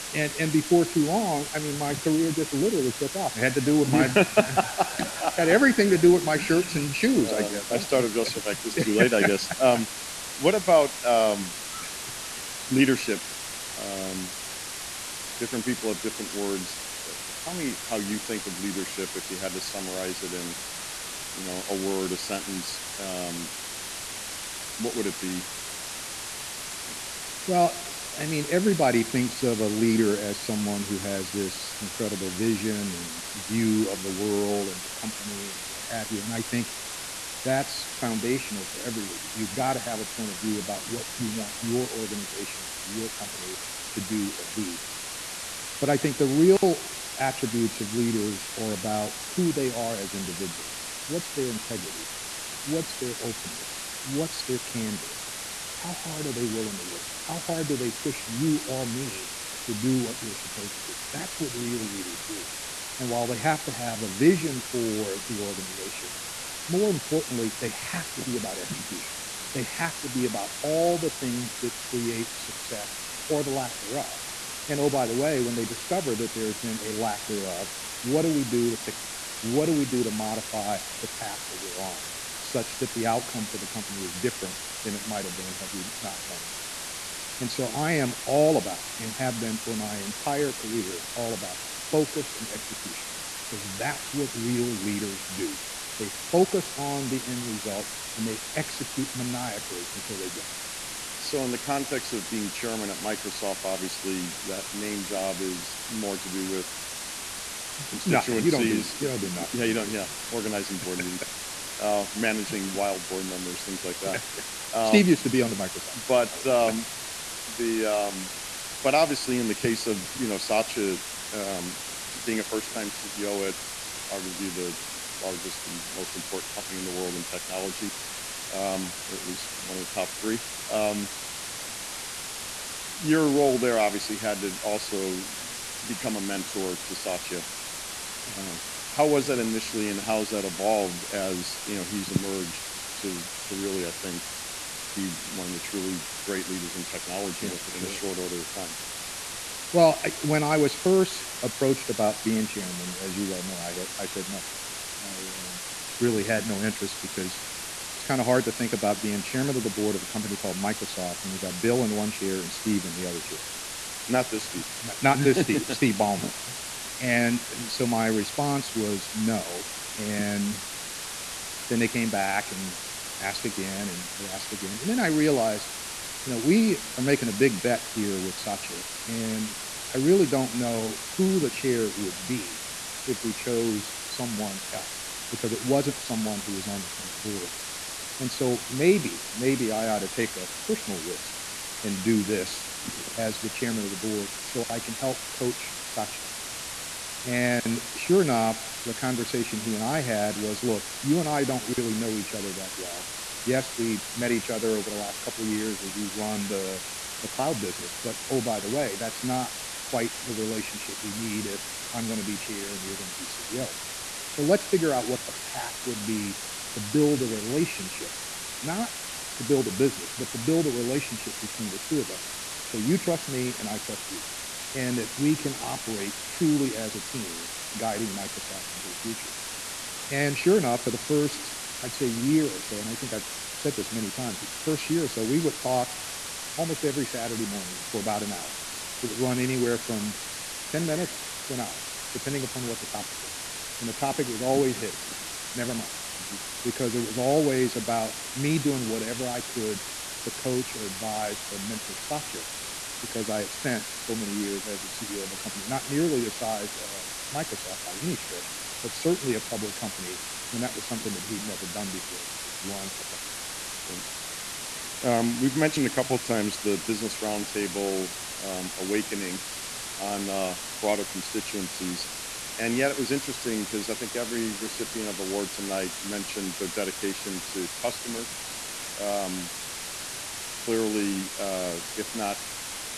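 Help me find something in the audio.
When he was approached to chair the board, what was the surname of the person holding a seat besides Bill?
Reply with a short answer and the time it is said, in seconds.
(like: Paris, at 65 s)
Ballmer, at 165 s.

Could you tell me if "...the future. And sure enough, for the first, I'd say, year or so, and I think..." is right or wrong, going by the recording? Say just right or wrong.
right.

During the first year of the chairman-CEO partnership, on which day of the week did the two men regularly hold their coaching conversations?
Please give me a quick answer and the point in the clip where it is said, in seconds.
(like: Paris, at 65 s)
Saturday, at 237 s.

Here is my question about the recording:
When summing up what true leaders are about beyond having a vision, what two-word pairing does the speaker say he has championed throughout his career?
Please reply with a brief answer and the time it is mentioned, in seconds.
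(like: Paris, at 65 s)
focus and execution, at 91 s.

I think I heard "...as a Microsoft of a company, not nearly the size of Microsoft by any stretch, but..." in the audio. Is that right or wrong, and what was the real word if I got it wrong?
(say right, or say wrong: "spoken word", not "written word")
wrong: "CEO", not "Microsoft".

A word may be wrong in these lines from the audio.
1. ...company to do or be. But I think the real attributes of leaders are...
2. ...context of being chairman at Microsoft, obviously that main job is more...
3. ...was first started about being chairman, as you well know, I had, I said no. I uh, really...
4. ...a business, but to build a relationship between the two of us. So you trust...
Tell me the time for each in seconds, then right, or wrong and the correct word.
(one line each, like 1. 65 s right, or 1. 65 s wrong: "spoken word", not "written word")
1. 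43 s right
2. 101 s right
3. 150 s wrong: "approached", not "started"
4. 219 s right.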